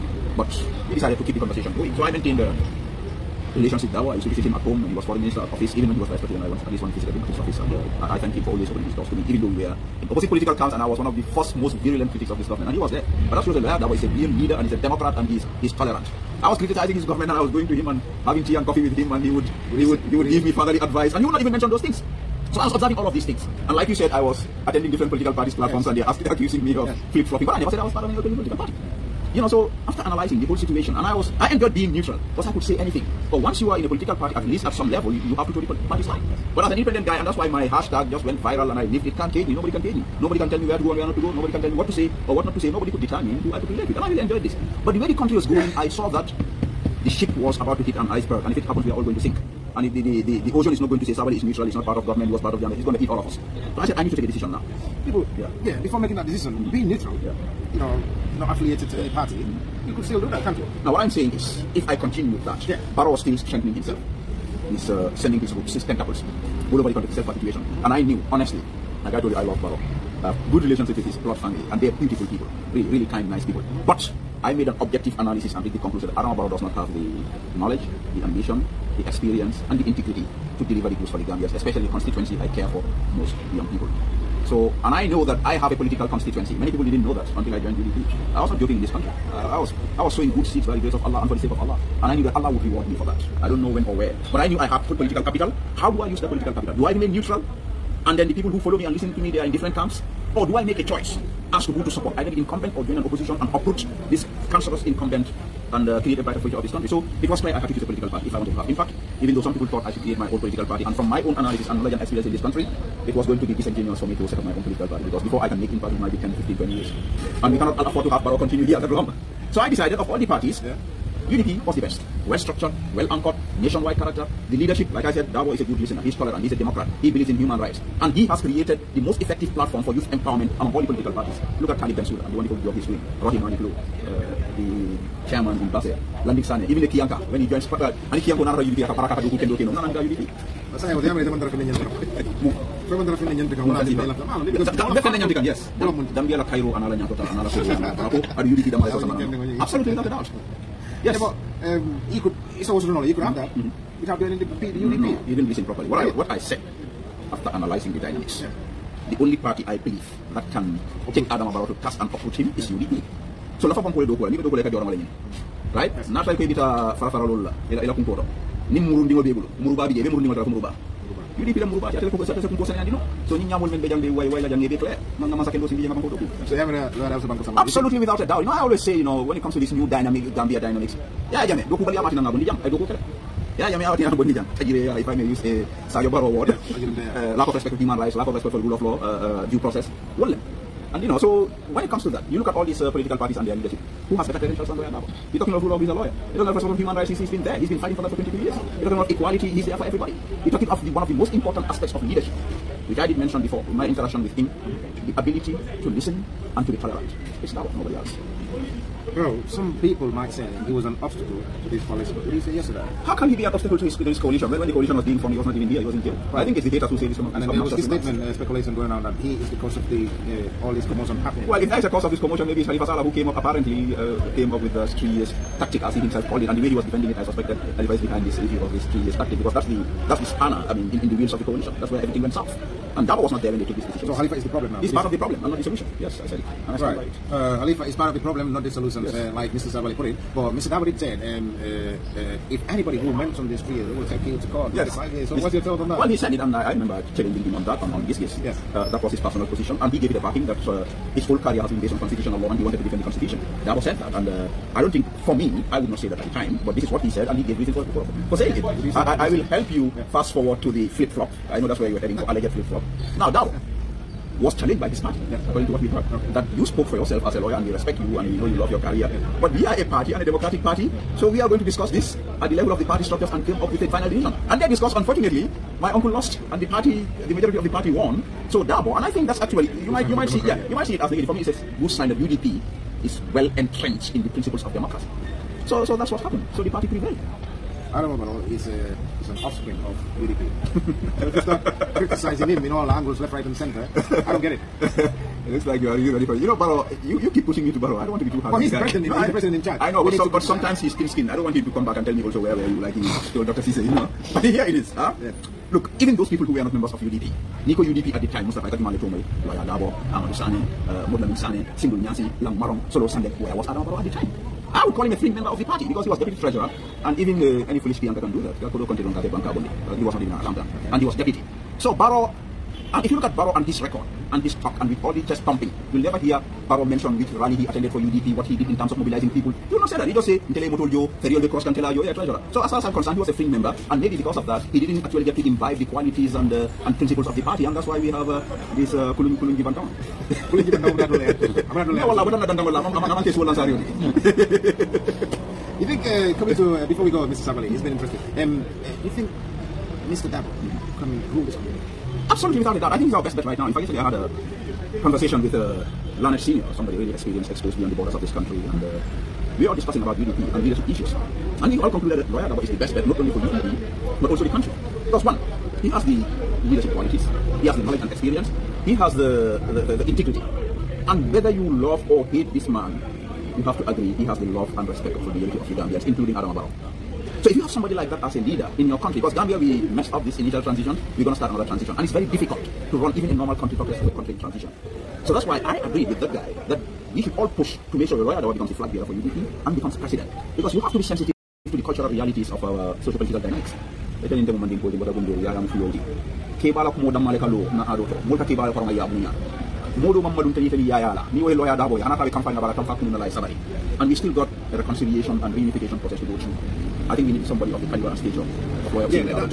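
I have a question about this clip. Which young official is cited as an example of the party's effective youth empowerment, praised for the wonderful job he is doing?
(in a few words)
Talib Bensouda.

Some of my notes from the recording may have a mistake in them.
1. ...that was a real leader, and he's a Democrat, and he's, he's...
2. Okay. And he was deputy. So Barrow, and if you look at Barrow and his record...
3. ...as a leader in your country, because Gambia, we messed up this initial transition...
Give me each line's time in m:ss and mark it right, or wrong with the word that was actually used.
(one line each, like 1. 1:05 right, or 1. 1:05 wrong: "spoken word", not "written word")
1. 0:13 right
2. 5:20 right
3. 6:18 right.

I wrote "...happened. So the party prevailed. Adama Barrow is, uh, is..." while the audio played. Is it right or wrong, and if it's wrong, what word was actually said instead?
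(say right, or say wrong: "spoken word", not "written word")
right.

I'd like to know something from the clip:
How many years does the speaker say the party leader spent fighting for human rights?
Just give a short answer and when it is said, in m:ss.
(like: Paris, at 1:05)
22, at 3:18.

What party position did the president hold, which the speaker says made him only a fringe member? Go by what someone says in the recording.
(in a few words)
Deputy treasurer.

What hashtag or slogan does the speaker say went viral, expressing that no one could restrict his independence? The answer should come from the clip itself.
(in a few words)
Can't cage me.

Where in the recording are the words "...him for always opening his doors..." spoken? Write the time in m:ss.
0:08.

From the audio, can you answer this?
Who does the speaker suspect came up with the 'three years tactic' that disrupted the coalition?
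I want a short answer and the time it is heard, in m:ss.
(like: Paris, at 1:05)
Halifa Sallah, at 3:42.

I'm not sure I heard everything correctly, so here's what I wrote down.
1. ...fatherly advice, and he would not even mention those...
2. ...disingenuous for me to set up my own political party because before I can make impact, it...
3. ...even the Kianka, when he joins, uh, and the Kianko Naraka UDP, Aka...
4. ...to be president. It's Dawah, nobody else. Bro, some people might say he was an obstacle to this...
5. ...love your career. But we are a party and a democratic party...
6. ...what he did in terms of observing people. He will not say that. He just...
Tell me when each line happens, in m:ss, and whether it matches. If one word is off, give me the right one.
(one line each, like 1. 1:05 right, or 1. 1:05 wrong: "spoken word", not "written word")
1. 0:20 right
2. 1:53 right
3. 2:16 right
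4. 3:26 wrong: "tolerant", not "president"
5. 4:28 right
6. 5:28 wrong: "mobilizing", not "observing".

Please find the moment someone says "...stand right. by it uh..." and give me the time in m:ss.
3:56.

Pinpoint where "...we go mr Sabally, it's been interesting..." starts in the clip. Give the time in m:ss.
5:47.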